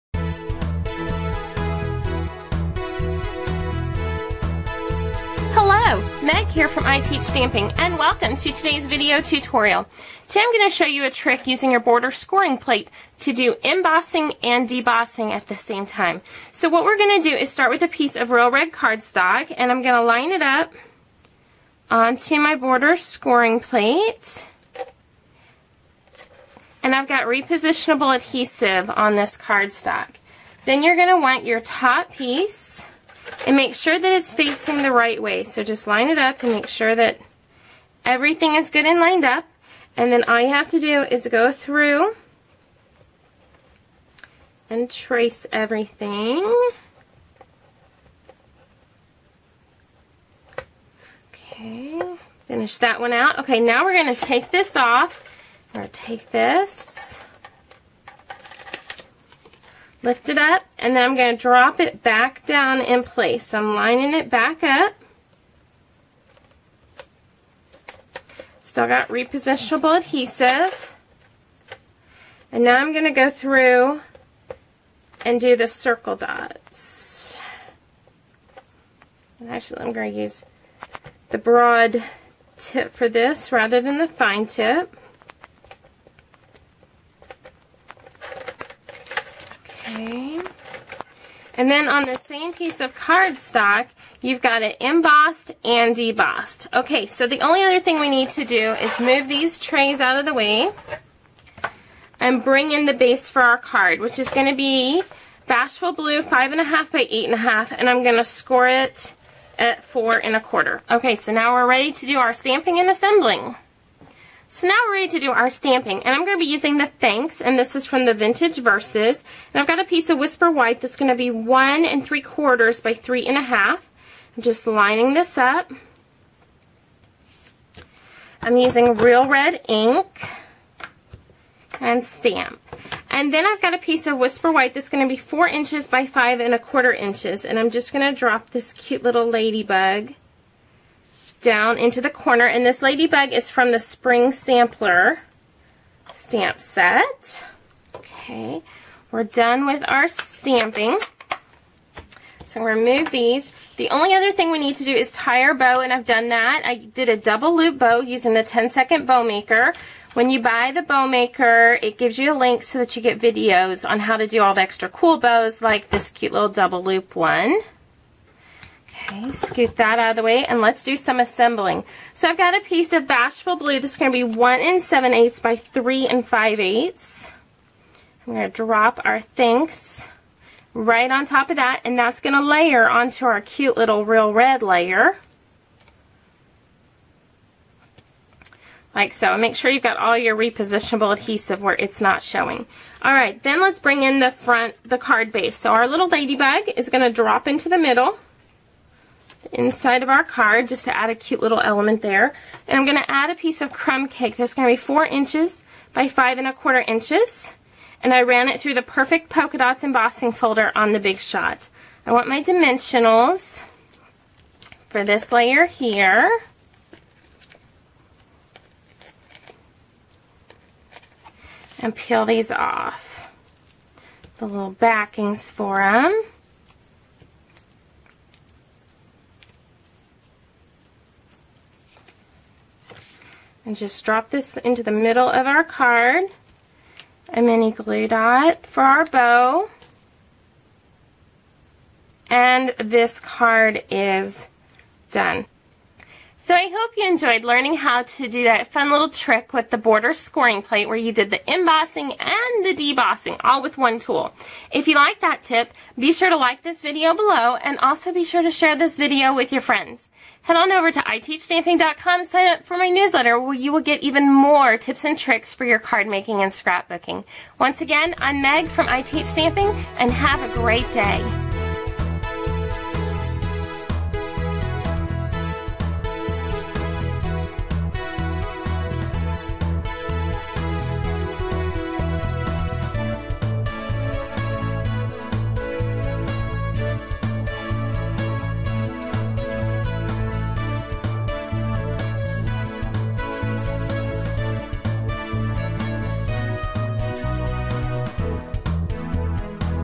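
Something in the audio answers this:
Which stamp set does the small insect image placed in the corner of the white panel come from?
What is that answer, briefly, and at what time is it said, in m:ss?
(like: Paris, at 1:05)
Spring Sampler, at 2:23.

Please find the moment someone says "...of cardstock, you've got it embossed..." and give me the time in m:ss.
1:32.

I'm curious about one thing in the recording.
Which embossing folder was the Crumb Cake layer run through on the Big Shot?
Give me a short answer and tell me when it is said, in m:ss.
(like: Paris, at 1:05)
Perfect Polka Dots, at 3:28.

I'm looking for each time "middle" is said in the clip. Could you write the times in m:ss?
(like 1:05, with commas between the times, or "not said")
3:17, 3:54.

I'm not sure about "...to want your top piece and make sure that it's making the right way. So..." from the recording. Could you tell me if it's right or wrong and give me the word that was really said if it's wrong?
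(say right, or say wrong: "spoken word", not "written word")
wrong: "facing", not "making".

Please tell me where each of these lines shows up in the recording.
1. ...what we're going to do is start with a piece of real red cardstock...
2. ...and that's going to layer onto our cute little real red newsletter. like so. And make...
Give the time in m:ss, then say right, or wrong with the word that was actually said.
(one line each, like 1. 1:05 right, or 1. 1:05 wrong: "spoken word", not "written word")
1. 0:16 right
2. 3:01 wrong: "layer", not "newsletter".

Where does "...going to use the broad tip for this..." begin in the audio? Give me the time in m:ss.
1:19.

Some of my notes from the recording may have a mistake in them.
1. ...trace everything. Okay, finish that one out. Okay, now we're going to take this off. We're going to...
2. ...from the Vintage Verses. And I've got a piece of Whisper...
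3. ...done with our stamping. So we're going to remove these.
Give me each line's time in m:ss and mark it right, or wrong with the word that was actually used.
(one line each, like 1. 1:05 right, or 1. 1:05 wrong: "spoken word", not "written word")
1. 0:44 right
2. 1:57 right
3. 2:29 right.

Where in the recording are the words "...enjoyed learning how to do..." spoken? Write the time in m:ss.
4:07.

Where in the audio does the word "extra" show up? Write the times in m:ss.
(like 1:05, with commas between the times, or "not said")
2:44.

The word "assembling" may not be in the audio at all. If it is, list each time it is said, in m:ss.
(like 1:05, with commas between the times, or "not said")
1:52, 2:51.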